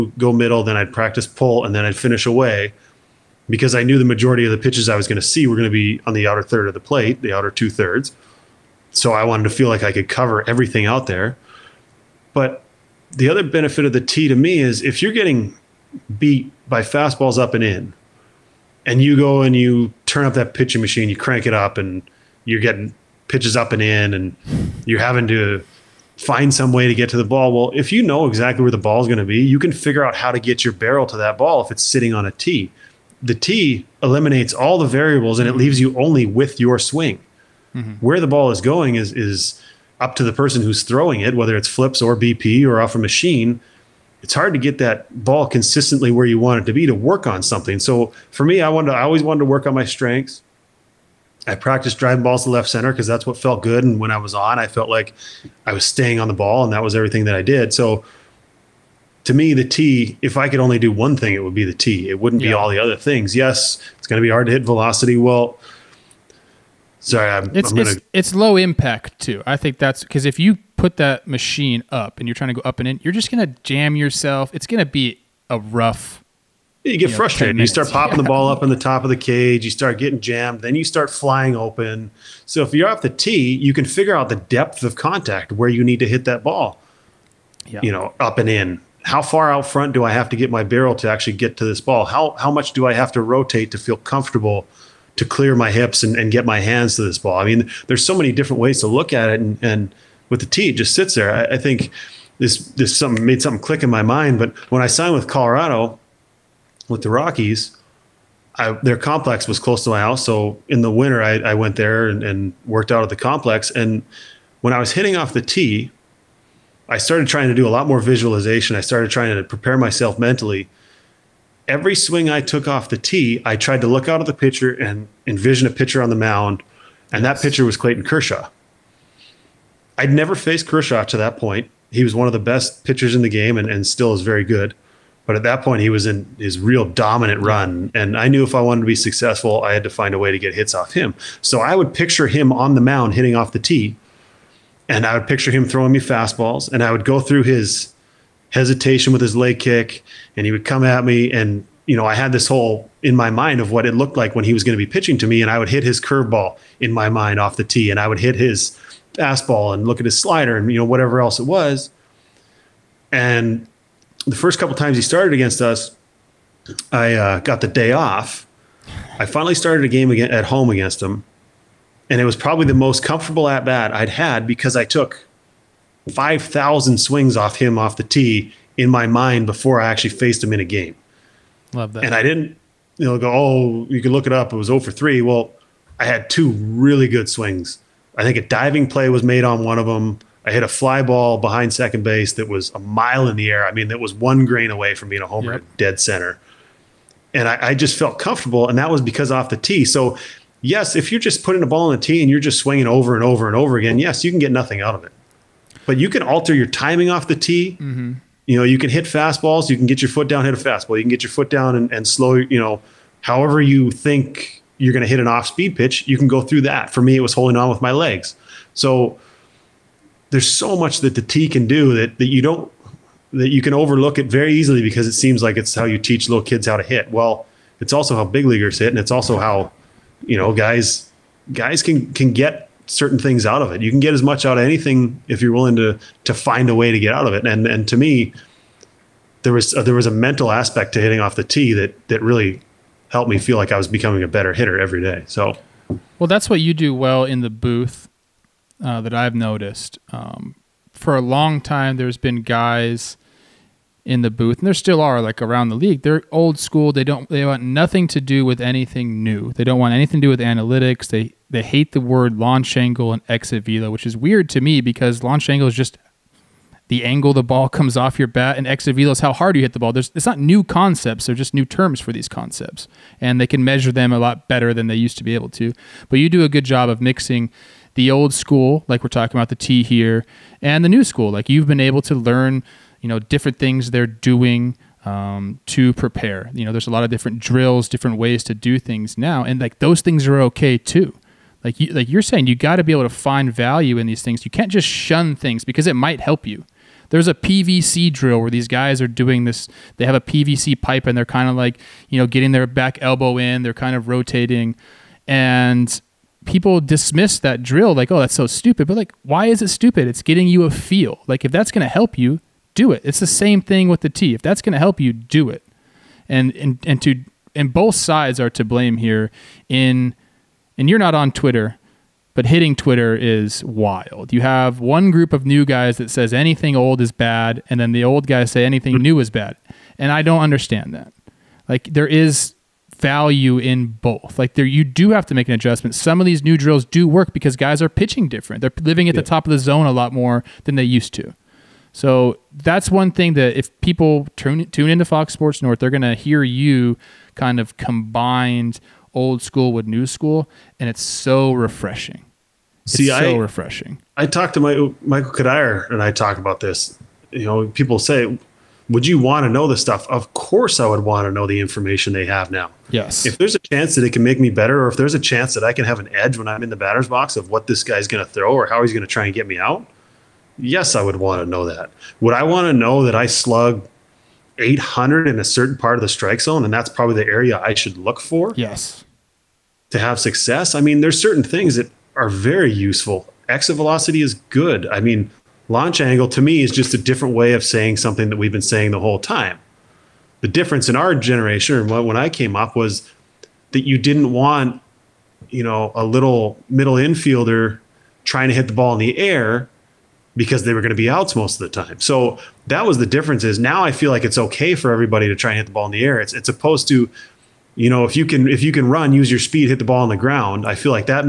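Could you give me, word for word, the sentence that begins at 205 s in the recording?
But you can alter your timing off the tee.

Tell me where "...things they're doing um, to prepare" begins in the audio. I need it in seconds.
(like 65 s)
283 s.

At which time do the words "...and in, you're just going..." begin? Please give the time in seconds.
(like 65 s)
72 s.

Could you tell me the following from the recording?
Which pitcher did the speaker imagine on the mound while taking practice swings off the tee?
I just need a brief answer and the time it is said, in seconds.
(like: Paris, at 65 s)
Clayton Kershaw, at 127 s.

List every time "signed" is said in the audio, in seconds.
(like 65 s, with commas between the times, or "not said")
104 s.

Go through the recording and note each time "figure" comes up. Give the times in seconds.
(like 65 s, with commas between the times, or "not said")
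29 s, 83 s.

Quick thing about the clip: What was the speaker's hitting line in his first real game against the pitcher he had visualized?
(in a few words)
0 for 3.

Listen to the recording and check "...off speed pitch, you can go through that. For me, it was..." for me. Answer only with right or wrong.
right.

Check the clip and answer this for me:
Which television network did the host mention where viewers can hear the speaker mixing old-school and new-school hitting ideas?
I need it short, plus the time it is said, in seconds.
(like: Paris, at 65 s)
Fox Sports North, at 345 s.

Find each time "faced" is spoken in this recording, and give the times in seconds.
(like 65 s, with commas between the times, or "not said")
130 s, 180 s.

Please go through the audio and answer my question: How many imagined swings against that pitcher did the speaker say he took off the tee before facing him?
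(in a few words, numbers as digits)
5000.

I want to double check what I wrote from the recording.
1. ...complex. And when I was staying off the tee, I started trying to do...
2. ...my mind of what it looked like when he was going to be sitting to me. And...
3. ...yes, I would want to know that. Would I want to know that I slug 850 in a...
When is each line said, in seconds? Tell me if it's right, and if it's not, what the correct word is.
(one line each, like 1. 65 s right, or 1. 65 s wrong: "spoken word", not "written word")
1. 113 s wrong: "hitting", not "staying"
2. 153 s wrong: "pitching", not "sitting"
3. 370 s wrong: "800", not "850".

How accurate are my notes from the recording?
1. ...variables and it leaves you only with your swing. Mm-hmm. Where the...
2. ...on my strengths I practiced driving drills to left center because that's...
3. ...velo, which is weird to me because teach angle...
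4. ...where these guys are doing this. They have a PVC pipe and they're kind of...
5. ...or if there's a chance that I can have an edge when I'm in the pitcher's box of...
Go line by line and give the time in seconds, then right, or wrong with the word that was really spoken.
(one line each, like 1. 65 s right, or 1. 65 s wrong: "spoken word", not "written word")
1. 34 s right
2. 49 s wrong: "balls", not "drills"
3. 263 s wrong: "launch", not "teach"
4. 298 s right
5. 364 s wrong: "batter", not "pitcher".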